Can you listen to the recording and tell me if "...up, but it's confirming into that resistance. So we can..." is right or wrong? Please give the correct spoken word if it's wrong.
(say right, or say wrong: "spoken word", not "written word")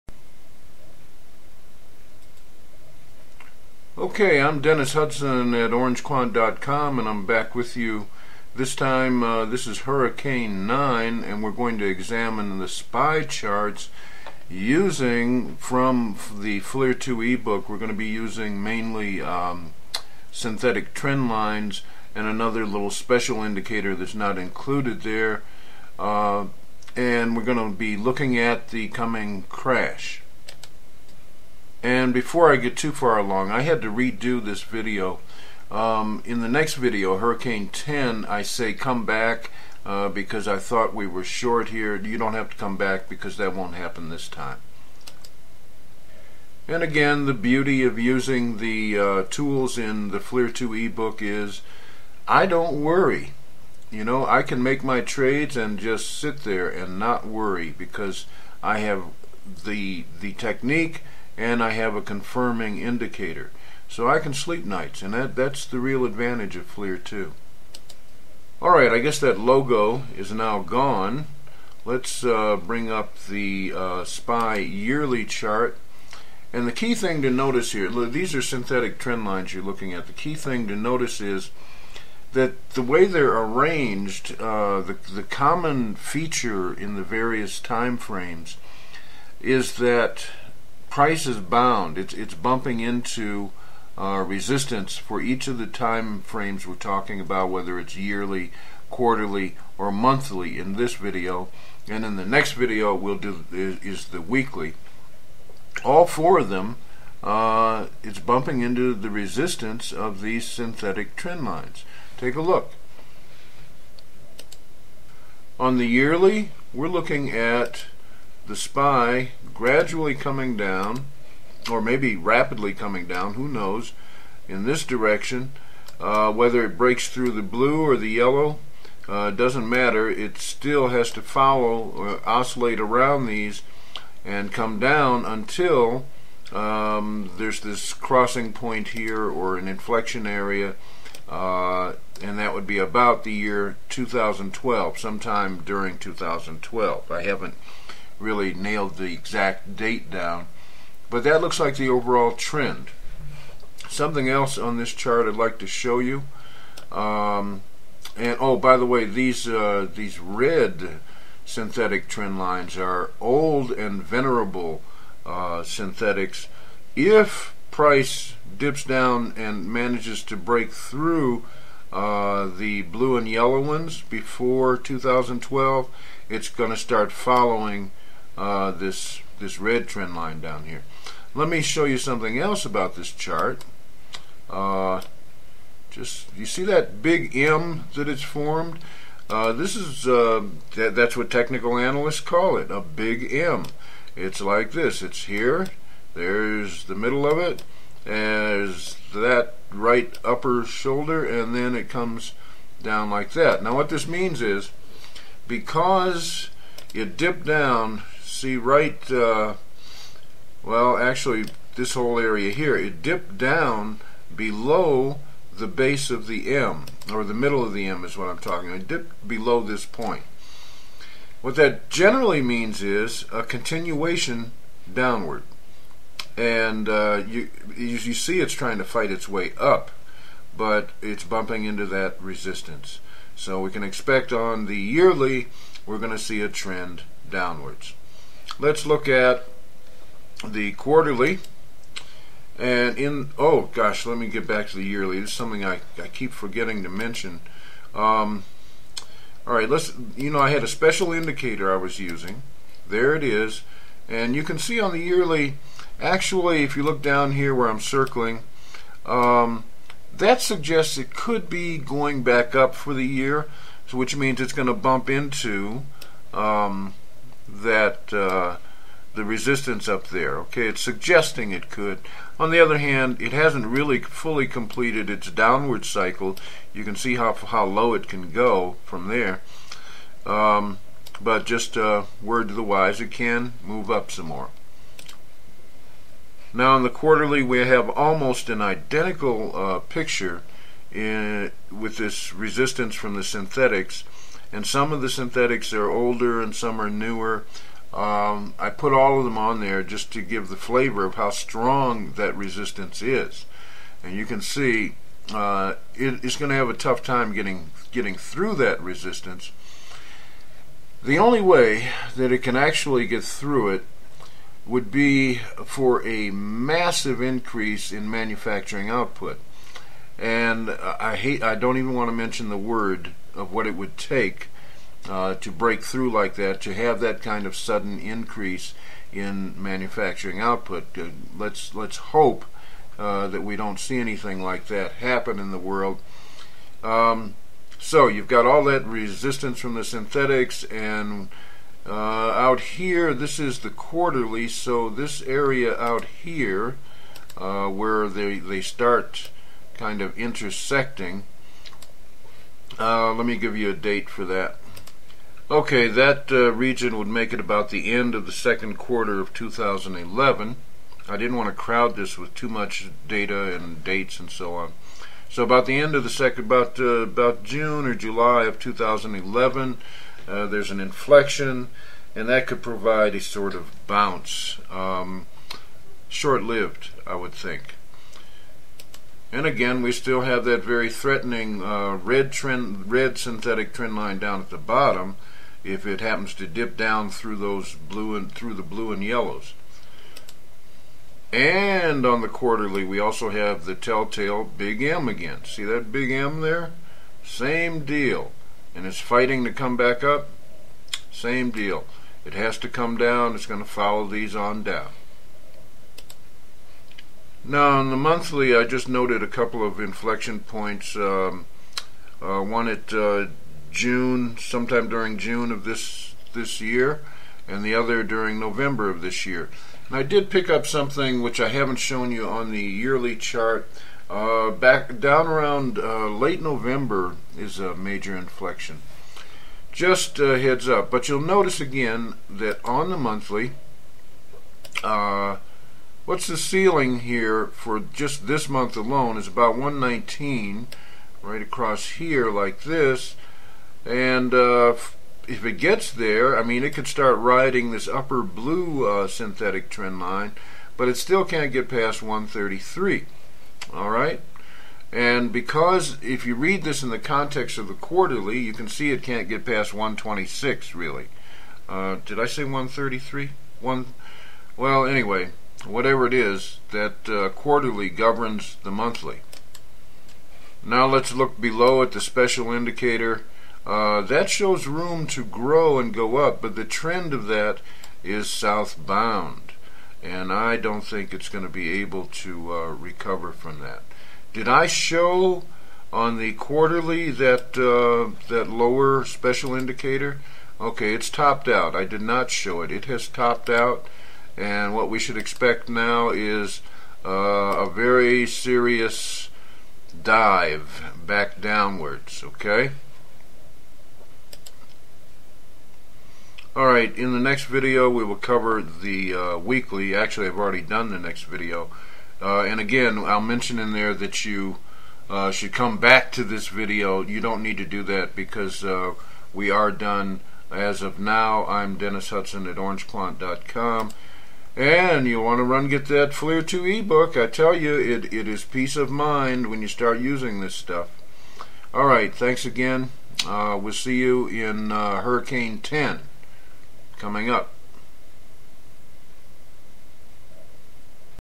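wrong: "bumping", not "confirming".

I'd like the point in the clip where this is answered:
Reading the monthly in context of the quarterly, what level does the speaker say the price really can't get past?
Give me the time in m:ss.
7:39.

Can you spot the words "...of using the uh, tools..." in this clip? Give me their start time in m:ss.
0:47.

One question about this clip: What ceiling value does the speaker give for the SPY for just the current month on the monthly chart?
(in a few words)
119.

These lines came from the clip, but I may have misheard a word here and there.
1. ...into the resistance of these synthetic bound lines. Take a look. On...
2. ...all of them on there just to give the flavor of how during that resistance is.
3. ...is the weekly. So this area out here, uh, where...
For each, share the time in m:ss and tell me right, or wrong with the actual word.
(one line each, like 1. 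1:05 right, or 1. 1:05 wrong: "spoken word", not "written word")
1. 1:48 wrong: "trend", not "bound"
2. 4:58 wrong: "strong", not "during"
3. 5:43 wrong: "quarterly", not "weekly".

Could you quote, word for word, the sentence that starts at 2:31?
But that looks like the overall trend.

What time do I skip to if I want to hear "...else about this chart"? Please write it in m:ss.
3:02.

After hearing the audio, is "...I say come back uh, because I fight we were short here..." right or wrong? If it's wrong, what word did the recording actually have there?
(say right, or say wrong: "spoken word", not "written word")
wrong: "thought", not "fight".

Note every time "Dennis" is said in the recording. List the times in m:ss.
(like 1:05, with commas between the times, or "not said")
0:04, 8:41.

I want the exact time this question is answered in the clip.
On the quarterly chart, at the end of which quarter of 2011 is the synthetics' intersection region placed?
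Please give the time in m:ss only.
5:58.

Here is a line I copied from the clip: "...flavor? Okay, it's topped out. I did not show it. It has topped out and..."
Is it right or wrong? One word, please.
wrong.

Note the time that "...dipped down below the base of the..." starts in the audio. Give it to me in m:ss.
3:33.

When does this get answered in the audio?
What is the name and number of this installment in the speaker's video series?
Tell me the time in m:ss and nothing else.
0:09.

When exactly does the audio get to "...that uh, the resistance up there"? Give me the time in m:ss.
4:27.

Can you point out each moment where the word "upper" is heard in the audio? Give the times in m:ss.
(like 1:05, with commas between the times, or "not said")
3:20, 7:27.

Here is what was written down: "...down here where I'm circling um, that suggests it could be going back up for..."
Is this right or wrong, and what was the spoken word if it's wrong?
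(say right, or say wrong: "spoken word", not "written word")
right.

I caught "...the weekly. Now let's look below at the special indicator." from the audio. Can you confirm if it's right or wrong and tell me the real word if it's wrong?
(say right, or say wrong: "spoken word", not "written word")
wrong: "monthly", not "weekly".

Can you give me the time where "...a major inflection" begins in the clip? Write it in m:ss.
7:07.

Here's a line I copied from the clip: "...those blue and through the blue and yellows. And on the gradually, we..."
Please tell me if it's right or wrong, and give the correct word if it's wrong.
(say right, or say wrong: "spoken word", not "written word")
wrong: "quarterly", not "gradually".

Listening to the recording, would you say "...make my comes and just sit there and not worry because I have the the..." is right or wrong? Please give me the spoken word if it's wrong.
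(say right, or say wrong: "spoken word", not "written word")
wrong: "trades", not "comes".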